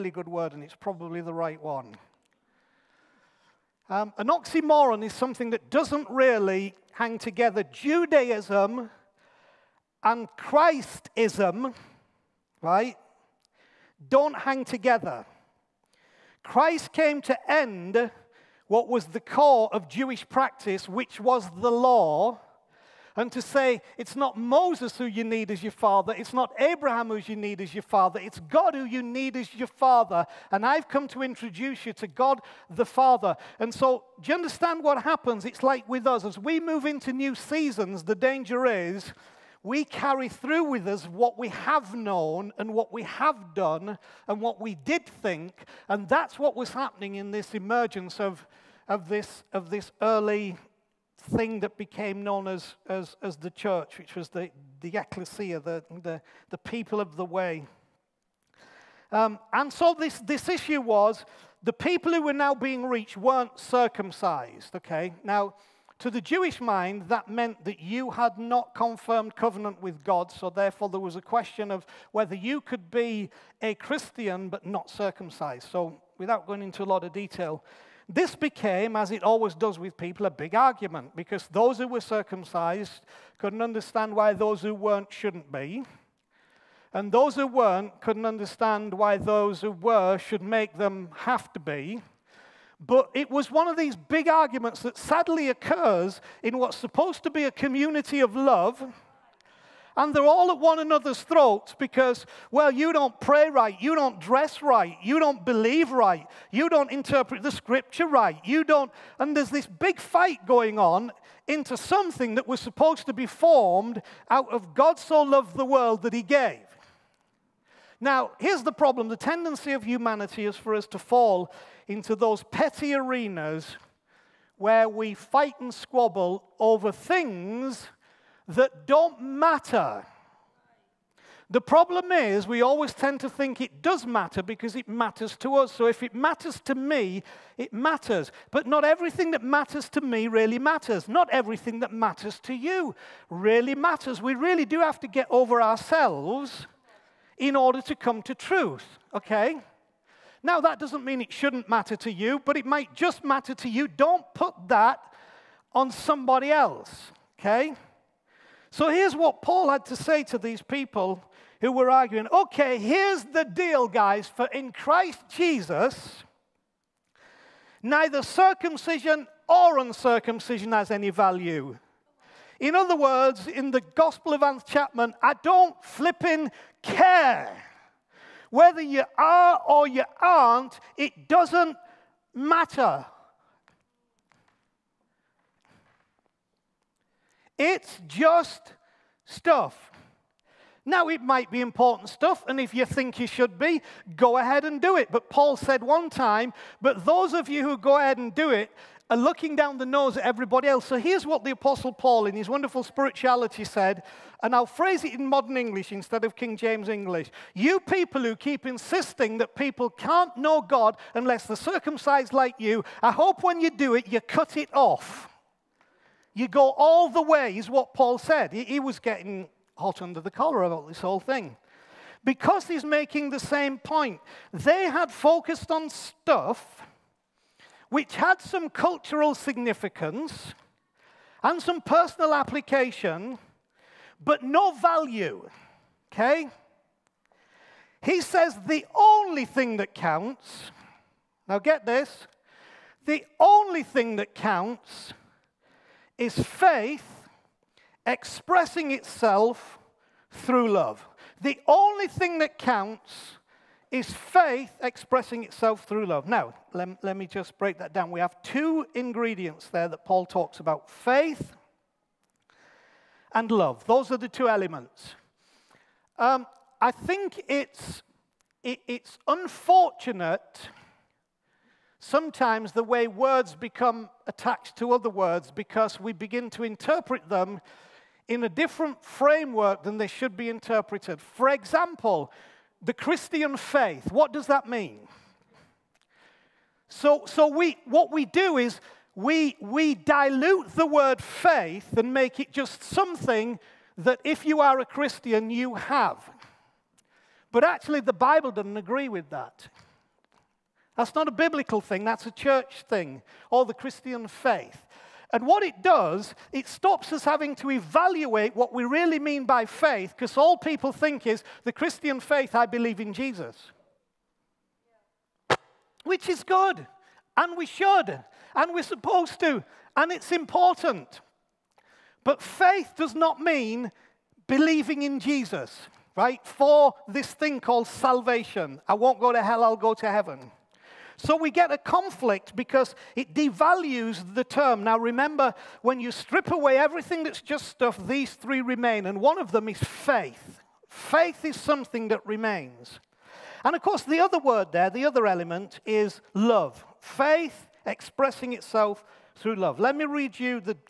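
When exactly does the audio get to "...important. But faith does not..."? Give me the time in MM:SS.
05:20.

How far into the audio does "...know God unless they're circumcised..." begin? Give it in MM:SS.
03:30.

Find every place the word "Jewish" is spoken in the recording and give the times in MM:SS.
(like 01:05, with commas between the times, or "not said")
00:19, 01:06.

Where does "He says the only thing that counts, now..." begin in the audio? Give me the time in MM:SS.
03:58.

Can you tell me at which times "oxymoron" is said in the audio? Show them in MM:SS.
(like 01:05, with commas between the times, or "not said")
00:04.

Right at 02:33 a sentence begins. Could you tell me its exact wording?
Don't put that on somebody else, okay?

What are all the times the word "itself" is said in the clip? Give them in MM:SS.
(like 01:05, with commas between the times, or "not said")
04:08, 04:15, 05:48.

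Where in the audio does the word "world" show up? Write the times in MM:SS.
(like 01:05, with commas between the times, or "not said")
01:55.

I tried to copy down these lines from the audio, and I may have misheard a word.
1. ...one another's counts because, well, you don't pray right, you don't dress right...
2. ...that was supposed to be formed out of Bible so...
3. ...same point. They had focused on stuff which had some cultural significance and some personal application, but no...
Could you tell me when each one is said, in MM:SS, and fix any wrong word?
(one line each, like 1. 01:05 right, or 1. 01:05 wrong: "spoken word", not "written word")
1. 01:40 wrong: "throats", not "counts"
2. 01:52 wrong: "God", not "Bible"
3. 03:43 right.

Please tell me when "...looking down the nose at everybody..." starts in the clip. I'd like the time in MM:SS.
03:19.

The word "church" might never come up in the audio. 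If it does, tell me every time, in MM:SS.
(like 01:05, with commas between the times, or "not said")
00:53, 05:02.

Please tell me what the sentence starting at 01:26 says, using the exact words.
And those who weren't couldn't understand why those who were should make them have to be.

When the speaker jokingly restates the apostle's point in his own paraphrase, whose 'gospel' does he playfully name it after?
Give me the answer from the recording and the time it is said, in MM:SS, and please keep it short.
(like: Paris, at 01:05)
Anth Chapman, at 02:54.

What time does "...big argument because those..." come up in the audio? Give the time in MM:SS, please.
01:20.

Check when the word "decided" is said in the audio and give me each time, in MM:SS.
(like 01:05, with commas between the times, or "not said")
not said.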